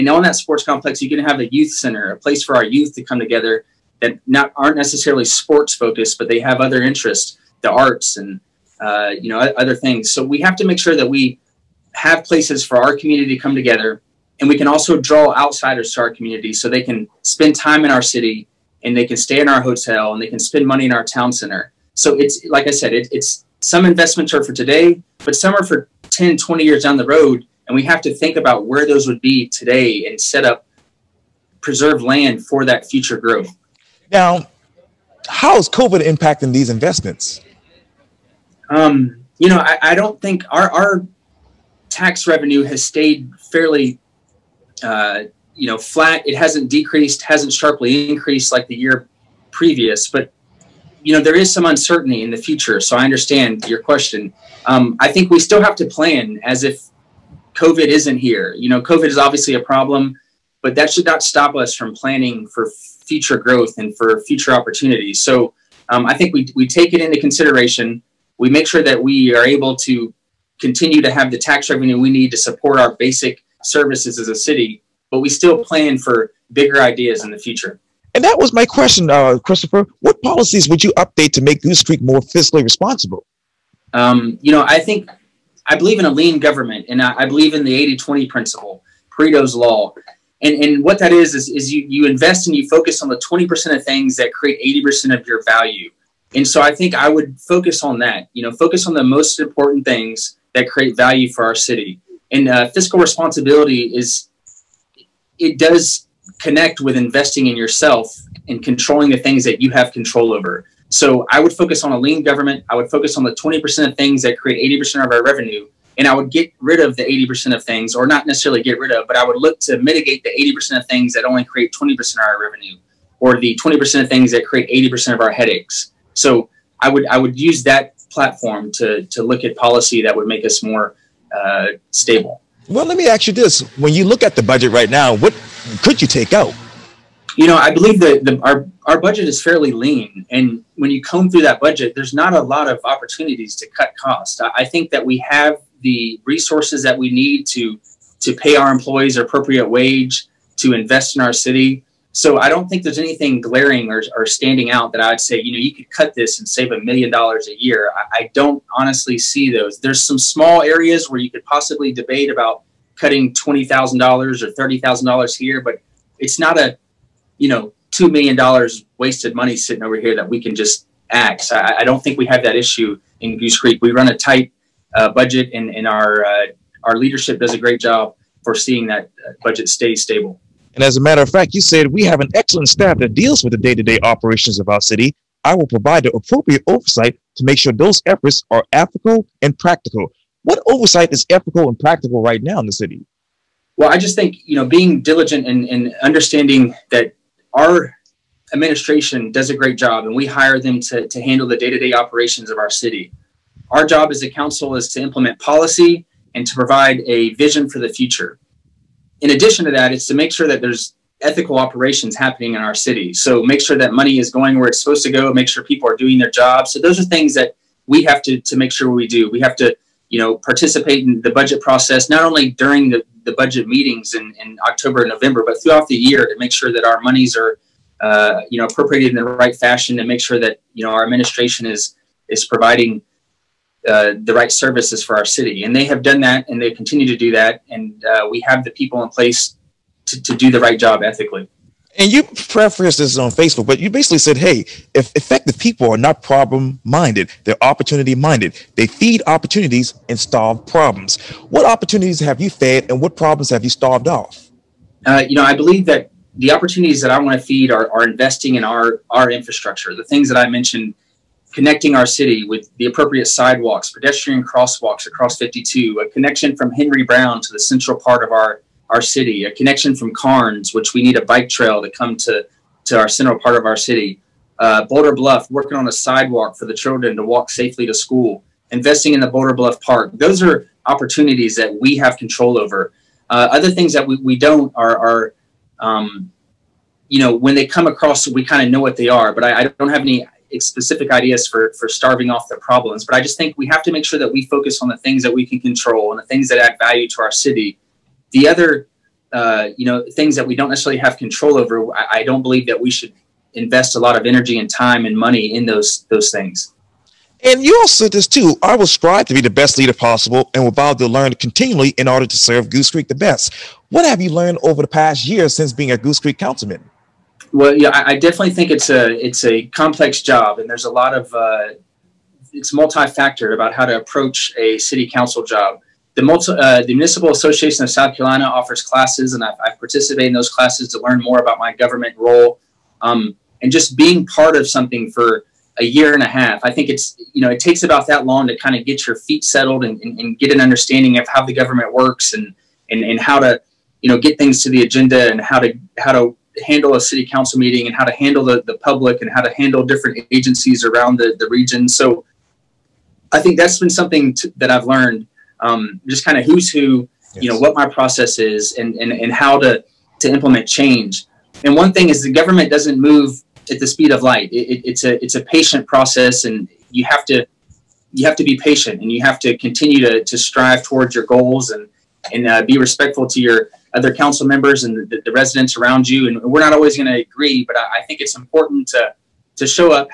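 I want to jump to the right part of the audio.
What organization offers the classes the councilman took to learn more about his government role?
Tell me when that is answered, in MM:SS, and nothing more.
05:26.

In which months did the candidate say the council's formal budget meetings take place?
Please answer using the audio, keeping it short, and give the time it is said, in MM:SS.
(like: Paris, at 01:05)
October and November, at 03:44.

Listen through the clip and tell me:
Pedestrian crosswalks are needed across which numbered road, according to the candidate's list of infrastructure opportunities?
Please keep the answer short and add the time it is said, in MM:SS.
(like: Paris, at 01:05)
52, at 04:25.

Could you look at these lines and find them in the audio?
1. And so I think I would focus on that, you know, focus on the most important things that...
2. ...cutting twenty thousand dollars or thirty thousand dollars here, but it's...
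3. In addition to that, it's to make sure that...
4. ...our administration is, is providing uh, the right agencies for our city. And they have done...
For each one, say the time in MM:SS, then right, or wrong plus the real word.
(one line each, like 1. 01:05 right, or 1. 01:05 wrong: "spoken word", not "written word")
1. 01:36 right
2. 02:43 right
3. 03:29 right
4. 03:50 wrong: "services", not "agencies".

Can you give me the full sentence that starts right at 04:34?
Uh, Boulder Bluff, working on a sidewalk for the children to walk safely to school, investing in the Boulder Bluff Park.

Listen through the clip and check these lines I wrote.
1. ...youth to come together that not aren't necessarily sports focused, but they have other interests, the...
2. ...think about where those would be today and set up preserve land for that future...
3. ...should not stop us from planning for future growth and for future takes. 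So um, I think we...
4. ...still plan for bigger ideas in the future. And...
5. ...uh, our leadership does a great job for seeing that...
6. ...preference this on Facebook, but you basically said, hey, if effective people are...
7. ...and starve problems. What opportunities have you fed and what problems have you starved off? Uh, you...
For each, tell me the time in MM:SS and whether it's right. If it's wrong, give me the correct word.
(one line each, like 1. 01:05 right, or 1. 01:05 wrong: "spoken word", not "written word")
1. 00:02 right
2. 00:28 right
3. 01:00 wrong: "opportunities", not "takes"
4. 01:15 right
5. 02:56 right
6. 04:02 right
7. 04:10 right.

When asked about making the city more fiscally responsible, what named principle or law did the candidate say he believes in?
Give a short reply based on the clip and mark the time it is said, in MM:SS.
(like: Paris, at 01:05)
Pareto's Law, at 01:29.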